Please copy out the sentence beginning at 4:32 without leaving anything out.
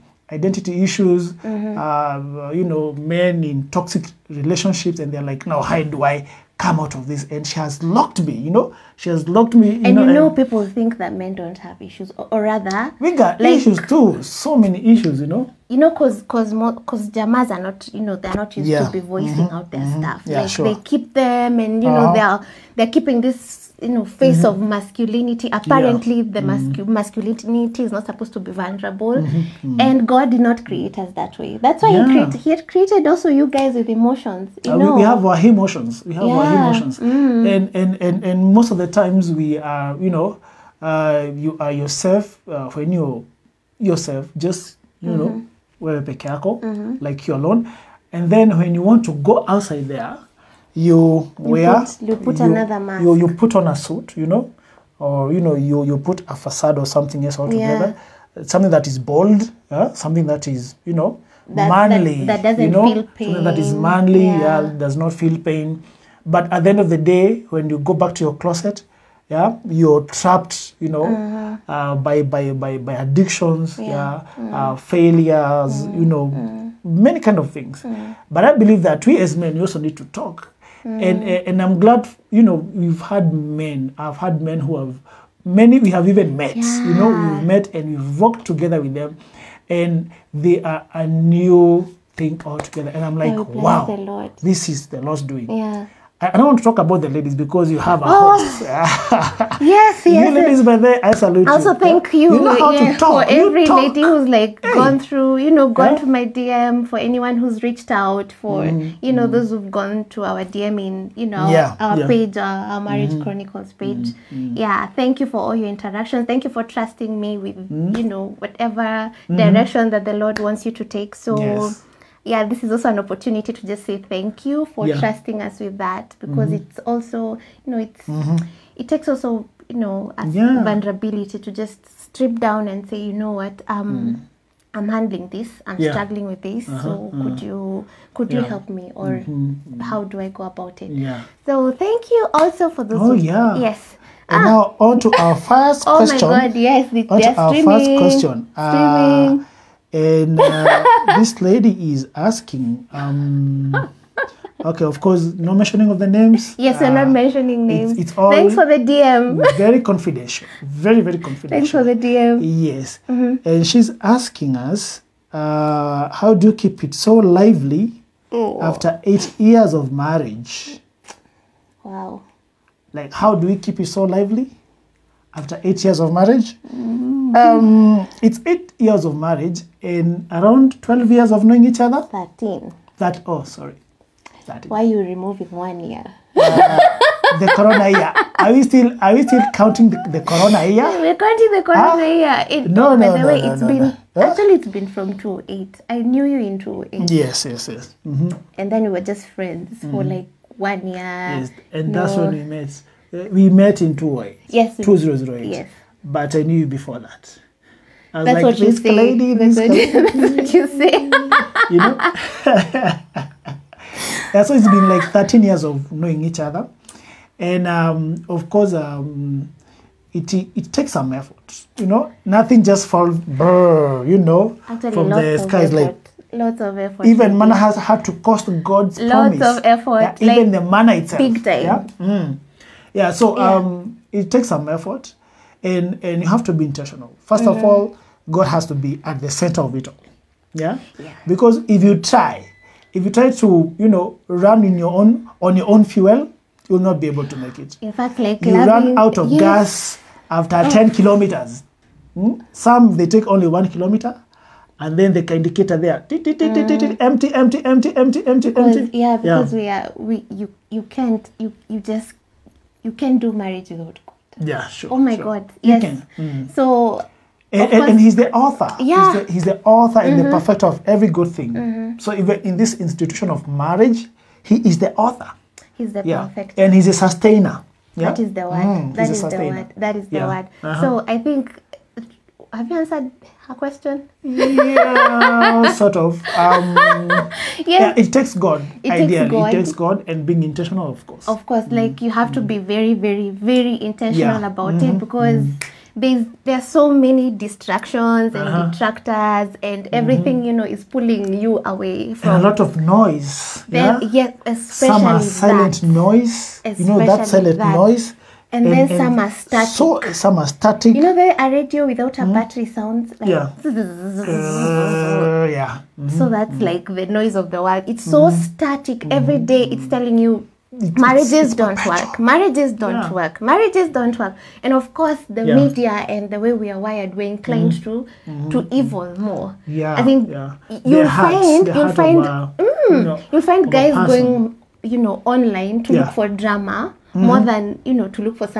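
So even in this institution of marriage, he is the author.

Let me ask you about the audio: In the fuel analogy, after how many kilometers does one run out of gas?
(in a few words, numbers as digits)
10.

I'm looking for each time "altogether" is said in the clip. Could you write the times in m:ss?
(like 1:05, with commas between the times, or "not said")
0:57, 1:32.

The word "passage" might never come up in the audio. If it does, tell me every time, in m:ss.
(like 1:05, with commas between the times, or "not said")
not said.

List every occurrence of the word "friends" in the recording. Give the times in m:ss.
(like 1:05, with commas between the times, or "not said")
3:19.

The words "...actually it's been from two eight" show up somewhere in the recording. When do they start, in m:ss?
3:14.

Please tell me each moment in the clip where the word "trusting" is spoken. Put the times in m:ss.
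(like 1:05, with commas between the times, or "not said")
1:56, 2:04.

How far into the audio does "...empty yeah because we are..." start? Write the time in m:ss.
4:18.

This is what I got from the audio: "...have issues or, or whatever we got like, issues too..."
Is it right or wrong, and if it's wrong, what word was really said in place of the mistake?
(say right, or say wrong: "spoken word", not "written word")
wrong: "rather", not "whatever".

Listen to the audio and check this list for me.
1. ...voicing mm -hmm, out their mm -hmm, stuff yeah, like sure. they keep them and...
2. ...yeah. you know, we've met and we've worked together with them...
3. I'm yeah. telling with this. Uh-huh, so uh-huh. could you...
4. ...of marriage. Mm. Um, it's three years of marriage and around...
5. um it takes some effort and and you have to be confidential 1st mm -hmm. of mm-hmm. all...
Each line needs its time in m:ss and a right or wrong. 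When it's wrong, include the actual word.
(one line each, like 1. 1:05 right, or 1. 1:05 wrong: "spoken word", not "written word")
1. 0:19 right
2. 1:26 right
3. 2:15 wrong: "struggling", not "telling"
4. 2:56 wrong: "eight", not "three"
5. 3:53 wrong: "intentional", not "confidential".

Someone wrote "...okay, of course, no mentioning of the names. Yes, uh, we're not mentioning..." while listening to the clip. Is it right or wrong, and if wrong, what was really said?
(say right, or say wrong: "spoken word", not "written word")
right.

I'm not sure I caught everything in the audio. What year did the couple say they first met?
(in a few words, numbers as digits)
2008.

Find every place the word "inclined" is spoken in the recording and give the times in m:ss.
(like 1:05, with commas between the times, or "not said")
5:27.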